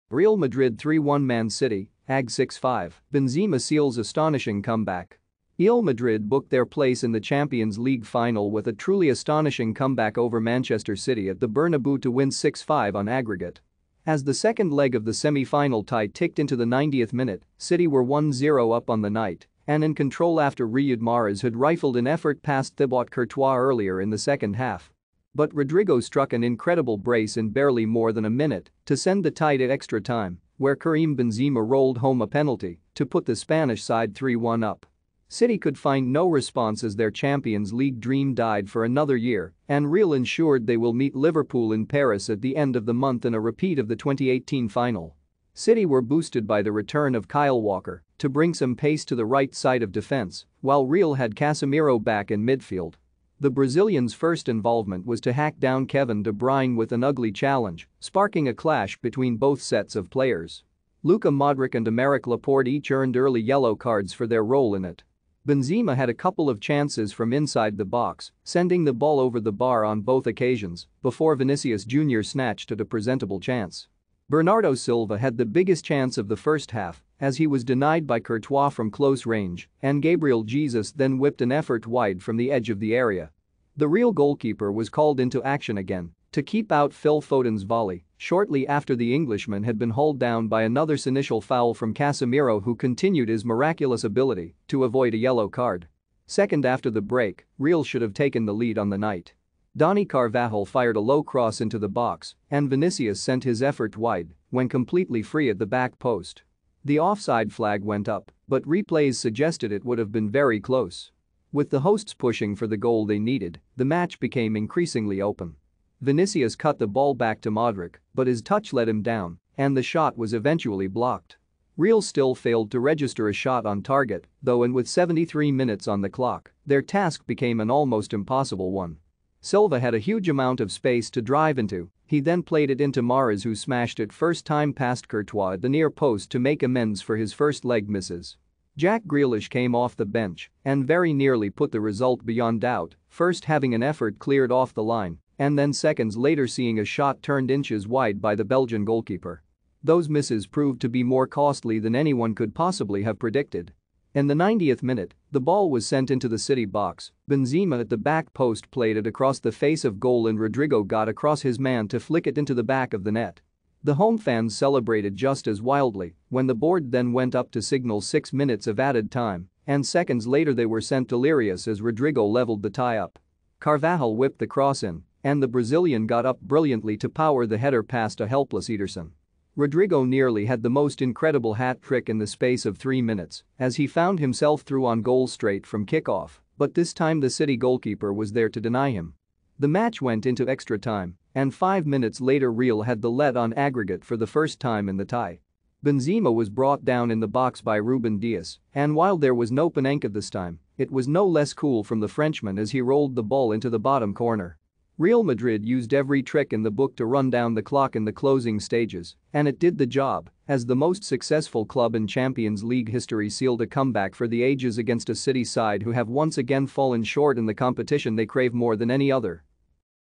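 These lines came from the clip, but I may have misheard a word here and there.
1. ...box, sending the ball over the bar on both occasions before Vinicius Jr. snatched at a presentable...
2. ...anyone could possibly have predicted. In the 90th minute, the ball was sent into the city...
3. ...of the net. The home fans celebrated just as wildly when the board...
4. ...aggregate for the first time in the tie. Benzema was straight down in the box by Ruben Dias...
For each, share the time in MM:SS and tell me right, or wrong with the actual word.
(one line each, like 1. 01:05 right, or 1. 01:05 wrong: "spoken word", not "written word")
1. 01:07 right
2. 02:31 right
3. 02:42 right
4. 03:13 wrong: "brought", not "straight".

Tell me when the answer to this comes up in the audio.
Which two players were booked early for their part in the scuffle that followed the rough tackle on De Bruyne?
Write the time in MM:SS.
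01:01.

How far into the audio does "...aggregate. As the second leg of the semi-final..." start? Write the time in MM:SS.
00:13.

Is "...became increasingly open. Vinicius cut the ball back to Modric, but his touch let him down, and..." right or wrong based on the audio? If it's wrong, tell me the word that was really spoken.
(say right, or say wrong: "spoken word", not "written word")
right.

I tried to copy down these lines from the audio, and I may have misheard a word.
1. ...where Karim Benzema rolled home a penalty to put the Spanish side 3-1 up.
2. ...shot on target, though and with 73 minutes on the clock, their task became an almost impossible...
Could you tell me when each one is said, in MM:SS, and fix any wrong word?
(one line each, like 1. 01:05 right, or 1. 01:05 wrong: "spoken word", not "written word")
1. 00:30 right
2. 02:03 right.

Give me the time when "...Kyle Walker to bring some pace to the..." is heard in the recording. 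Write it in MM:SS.
00:47.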